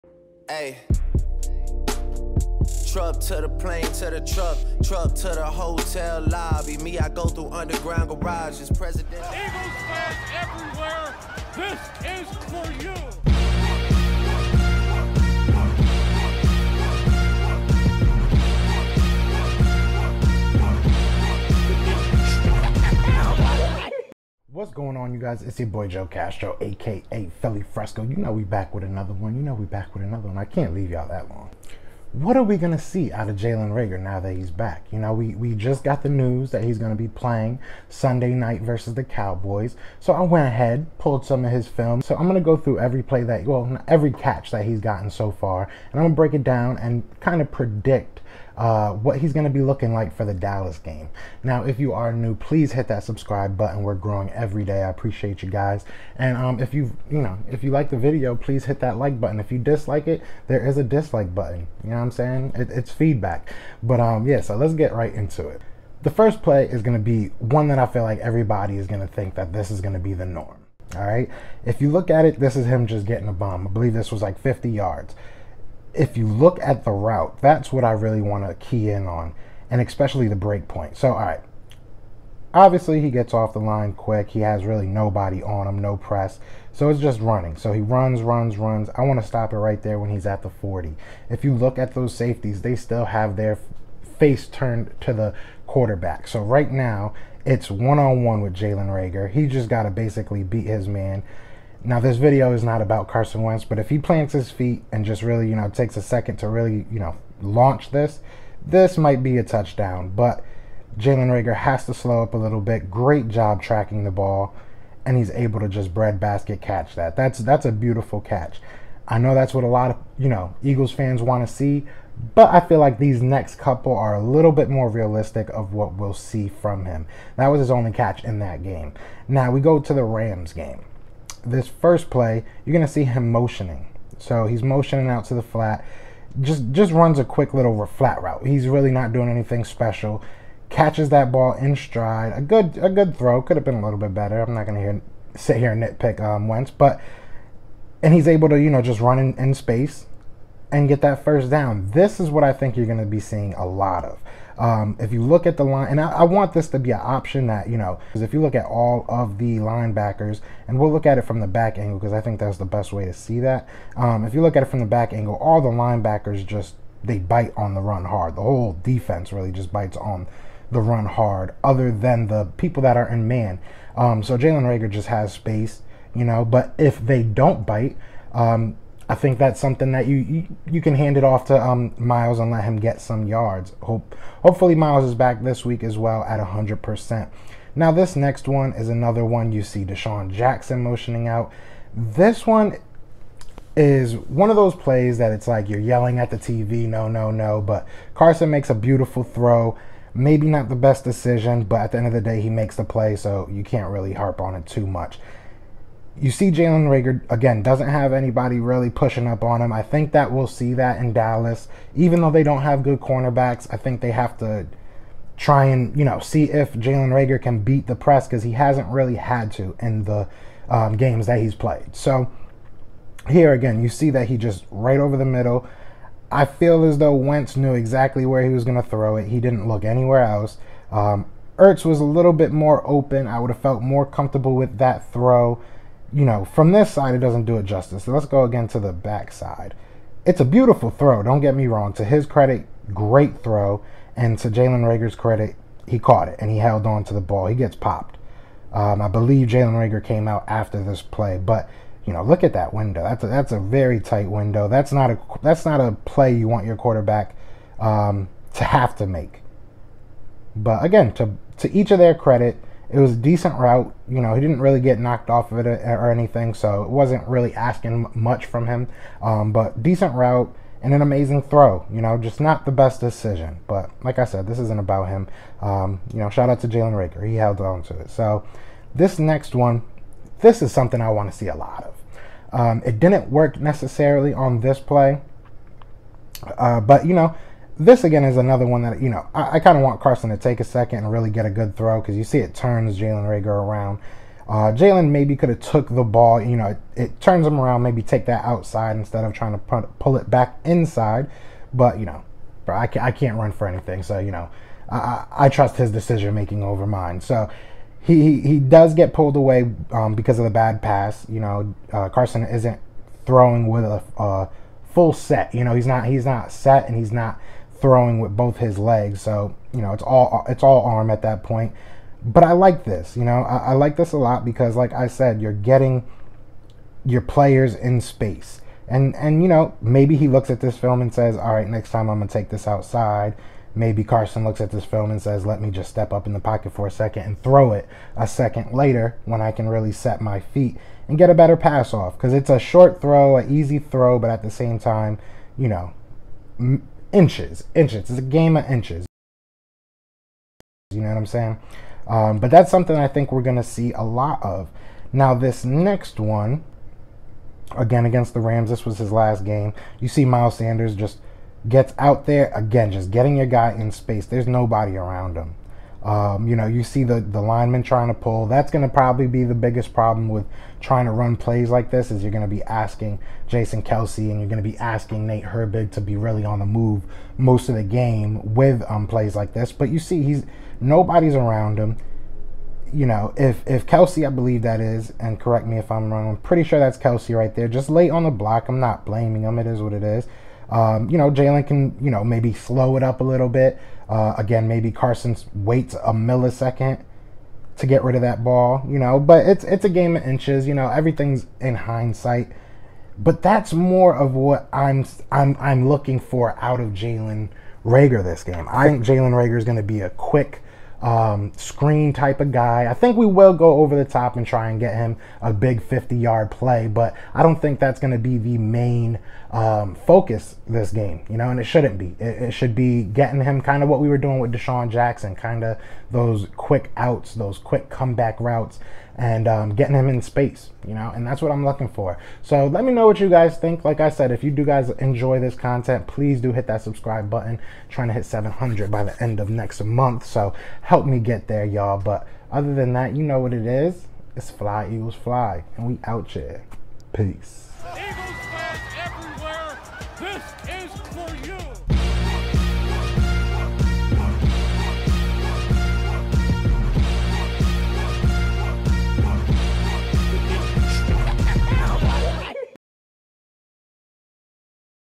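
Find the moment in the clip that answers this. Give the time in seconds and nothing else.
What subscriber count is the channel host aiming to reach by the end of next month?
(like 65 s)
438 s.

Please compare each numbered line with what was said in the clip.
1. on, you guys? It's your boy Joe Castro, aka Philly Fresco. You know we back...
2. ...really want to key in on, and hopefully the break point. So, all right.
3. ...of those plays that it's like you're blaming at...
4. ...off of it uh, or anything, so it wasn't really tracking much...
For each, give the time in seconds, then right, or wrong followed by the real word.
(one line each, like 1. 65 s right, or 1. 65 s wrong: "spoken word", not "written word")
1. 25 s right
2. 77 s wrong: "especially", not "hopefully"
3. 194 s wrong: "yelling", not "blaming"
4. 265 s wrong: "asking", not "tracking".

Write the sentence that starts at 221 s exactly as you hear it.
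So here again, you see that he just right over the middle.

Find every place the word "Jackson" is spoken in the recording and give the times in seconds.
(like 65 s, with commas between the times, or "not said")
190 s, 424 s.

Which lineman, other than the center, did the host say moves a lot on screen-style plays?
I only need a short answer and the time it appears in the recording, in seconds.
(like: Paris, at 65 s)
Nate Herbig, at 375 s.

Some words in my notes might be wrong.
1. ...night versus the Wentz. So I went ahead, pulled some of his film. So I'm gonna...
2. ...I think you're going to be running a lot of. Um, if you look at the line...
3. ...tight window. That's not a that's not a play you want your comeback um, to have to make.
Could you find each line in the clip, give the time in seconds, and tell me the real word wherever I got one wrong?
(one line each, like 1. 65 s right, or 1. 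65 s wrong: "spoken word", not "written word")
1. 38 s wrong: "Cowboys", not "Wentz"
2. 152 s wrong: "seeing", not "running"
3. 253 s wrong: "quarterback", not "comeback".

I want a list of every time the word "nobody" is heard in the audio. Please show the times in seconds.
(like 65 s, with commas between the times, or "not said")
84 s, 364 s, 380 s.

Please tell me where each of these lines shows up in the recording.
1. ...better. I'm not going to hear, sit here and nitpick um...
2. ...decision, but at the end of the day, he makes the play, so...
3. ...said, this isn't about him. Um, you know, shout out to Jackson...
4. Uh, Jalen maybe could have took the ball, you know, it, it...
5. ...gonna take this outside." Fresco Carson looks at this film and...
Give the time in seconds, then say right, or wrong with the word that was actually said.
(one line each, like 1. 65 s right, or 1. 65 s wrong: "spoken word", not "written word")
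1. 144 s right
2. 201 s right
3. 274 s wrong: "Jalen", not "Jackson"
4. 294 s right
5. 332 s wrong: "Maybe", not "Fresco".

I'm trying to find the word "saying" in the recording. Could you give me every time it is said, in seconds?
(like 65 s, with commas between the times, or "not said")
62 s, 351 s.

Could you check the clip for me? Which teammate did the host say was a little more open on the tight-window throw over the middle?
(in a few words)
Ertz.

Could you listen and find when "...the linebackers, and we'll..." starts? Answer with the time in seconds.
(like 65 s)
159 s.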